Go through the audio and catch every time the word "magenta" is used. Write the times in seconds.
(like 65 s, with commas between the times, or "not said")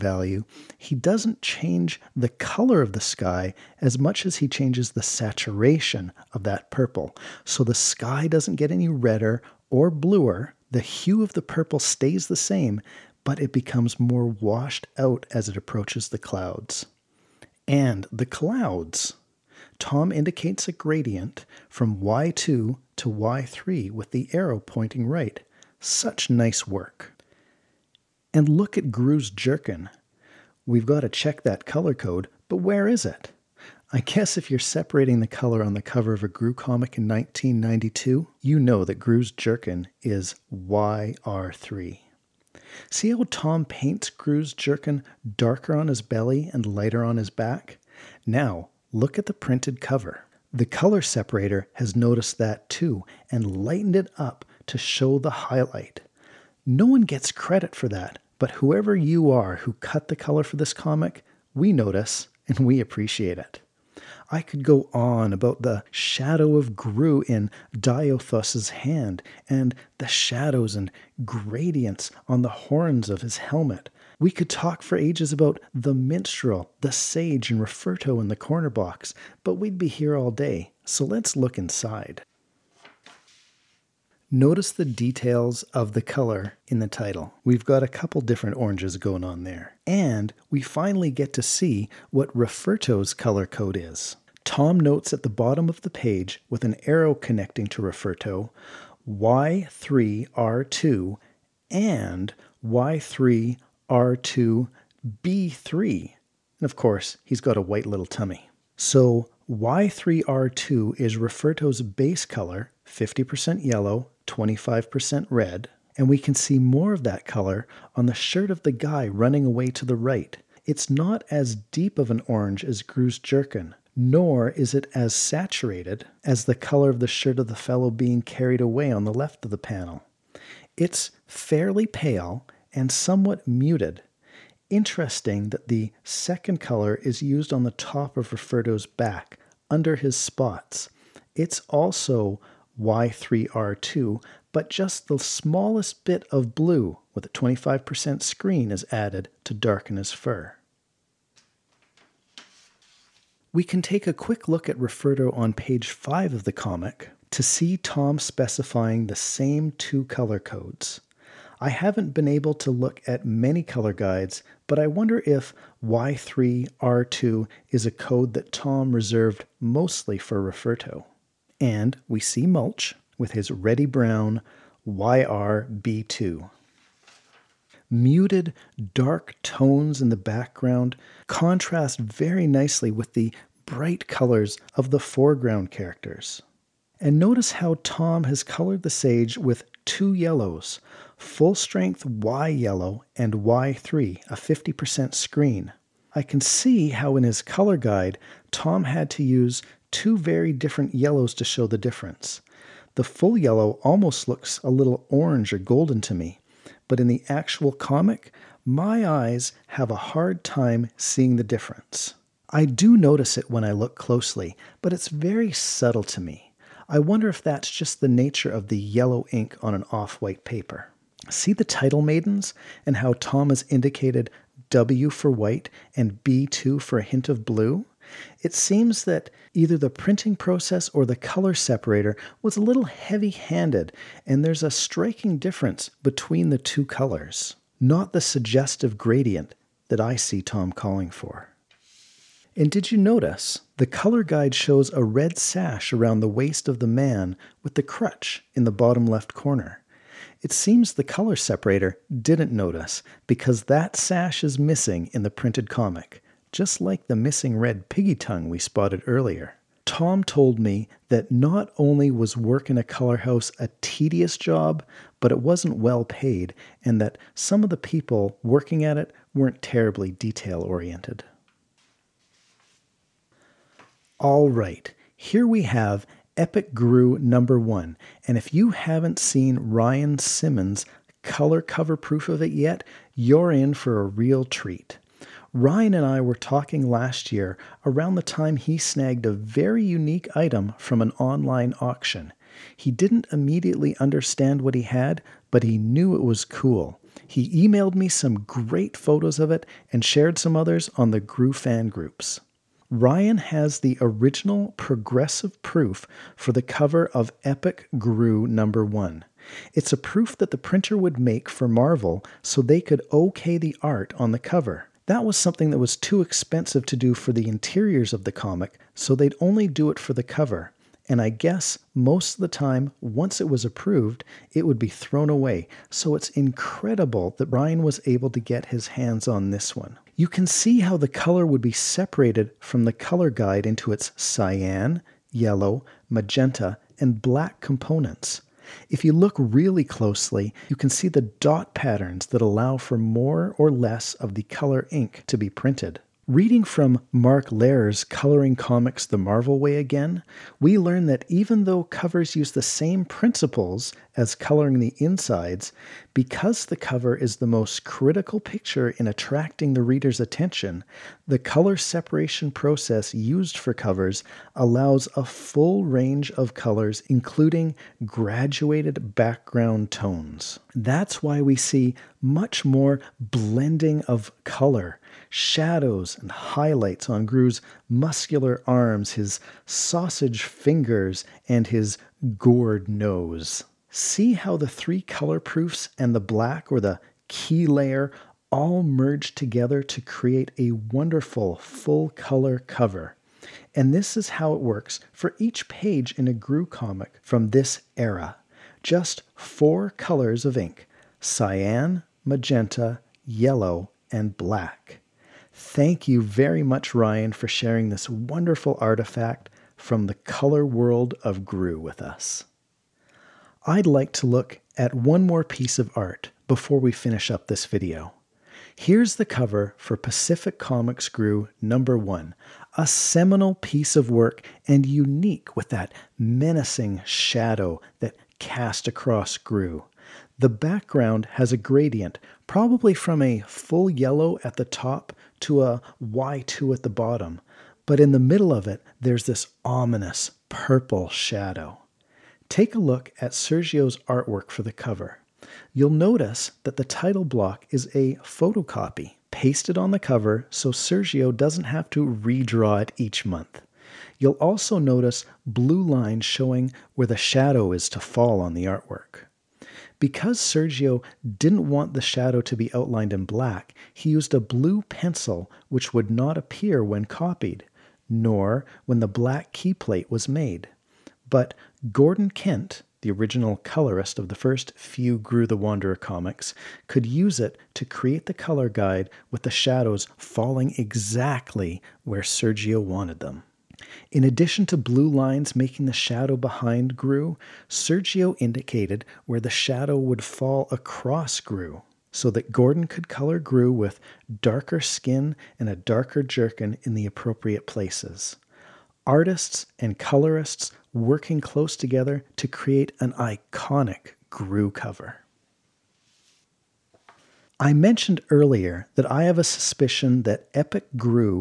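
336 s, 402 s.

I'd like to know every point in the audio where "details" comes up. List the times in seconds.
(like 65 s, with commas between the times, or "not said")
84 s, 270 s.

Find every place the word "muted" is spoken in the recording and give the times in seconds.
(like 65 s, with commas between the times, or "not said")
133 s, 177 s.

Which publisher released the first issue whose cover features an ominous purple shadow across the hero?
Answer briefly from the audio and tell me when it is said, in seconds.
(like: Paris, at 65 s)
Pacific Comics, at 419 s.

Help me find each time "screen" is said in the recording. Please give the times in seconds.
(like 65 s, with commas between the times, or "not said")
148 s, 195 s.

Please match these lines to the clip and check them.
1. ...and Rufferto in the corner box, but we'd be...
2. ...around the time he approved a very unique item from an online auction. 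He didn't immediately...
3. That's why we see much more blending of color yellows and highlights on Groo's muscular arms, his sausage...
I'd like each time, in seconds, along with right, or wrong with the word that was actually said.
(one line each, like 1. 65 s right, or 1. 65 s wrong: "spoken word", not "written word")
1. 77 s right
2. 287 s wrong: "snagged", not "approved"
3. 370 s wrong: "shadows", not "yellows".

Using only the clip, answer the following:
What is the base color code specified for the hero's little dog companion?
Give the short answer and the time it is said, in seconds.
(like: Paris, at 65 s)
Y3R2, at 108 s.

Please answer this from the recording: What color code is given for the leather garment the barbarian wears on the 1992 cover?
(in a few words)
YR3.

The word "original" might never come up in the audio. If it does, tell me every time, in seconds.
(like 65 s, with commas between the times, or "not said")
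303 s, 473 s.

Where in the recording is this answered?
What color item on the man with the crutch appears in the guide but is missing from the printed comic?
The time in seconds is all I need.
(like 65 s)
245 s.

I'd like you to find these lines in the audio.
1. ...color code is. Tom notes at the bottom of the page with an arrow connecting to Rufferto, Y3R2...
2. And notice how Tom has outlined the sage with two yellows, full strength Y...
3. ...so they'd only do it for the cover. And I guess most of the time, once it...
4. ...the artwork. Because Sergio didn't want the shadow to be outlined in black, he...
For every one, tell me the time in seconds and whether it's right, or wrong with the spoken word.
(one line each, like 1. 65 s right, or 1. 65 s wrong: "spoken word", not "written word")
1. 93 s right
2. 186 s wrong: "colored", not "outlined"
3. 318 s right
4. 458 s right.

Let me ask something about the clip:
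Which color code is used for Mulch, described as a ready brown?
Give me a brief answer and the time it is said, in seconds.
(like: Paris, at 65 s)
YRB2, at 174 s.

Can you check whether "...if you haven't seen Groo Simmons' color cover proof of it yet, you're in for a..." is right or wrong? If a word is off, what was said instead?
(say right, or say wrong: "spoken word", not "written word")
wrong: "Ryan", not "Groo".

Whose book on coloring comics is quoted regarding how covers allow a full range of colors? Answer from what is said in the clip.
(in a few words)
Mark Lair.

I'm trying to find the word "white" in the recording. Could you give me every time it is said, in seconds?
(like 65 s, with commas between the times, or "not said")
107 s, 220 s, 225 s.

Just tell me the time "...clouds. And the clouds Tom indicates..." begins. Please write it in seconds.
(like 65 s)
16 s.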